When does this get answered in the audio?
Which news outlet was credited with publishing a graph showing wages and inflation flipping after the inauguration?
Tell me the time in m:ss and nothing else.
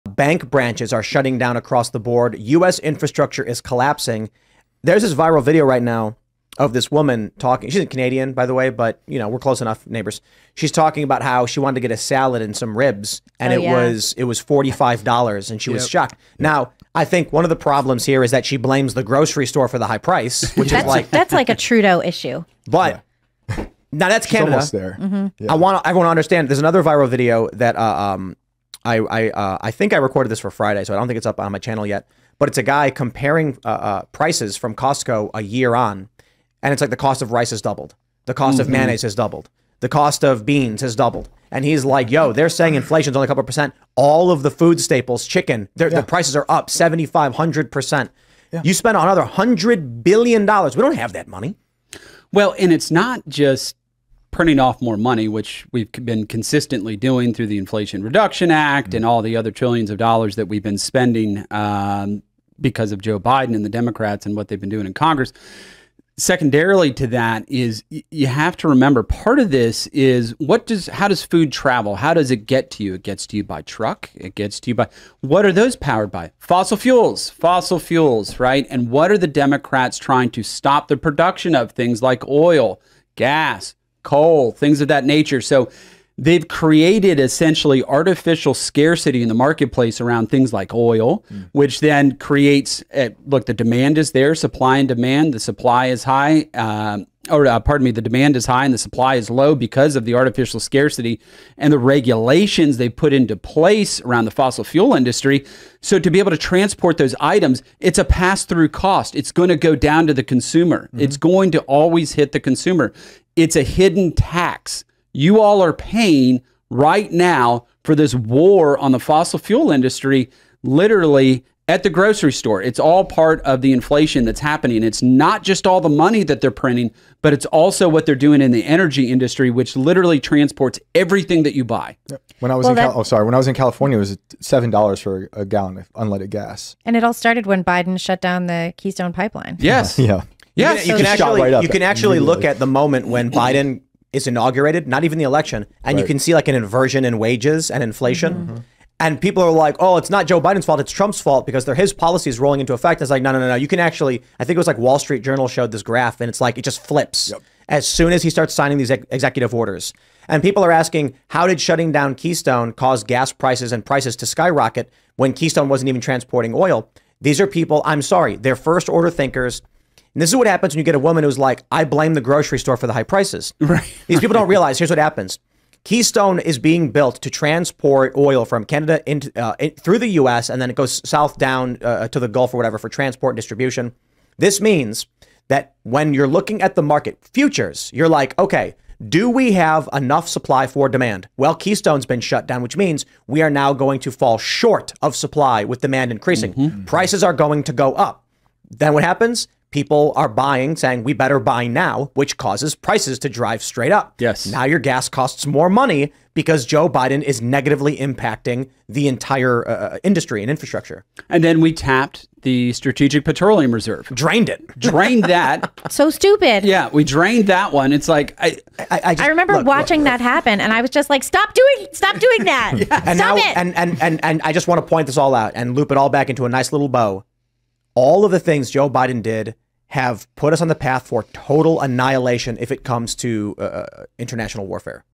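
2:34.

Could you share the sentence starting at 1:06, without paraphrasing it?
Secondarily to that is you have to remember part of this is what does how does food travel?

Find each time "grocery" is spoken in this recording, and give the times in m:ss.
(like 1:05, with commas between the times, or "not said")
0:19, 2:01, 2:52.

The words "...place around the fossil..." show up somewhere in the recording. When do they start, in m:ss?
1:43.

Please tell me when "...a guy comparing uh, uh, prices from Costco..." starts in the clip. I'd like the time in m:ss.
0:32.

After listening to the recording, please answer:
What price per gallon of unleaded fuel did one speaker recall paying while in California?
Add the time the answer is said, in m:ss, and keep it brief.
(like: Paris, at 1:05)
$7, at 2:14.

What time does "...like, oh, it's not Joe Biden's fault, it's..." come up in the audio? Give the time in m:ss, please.
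2:29.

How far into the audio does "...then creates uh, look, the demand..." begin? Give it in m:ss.
1:31.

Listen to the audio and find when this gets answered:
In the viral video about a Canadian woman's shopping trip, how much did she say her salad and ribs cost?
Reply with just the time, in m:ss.
0:14.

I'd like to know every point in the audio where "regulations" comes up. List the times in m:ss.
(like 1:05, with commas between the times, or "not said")
1:41.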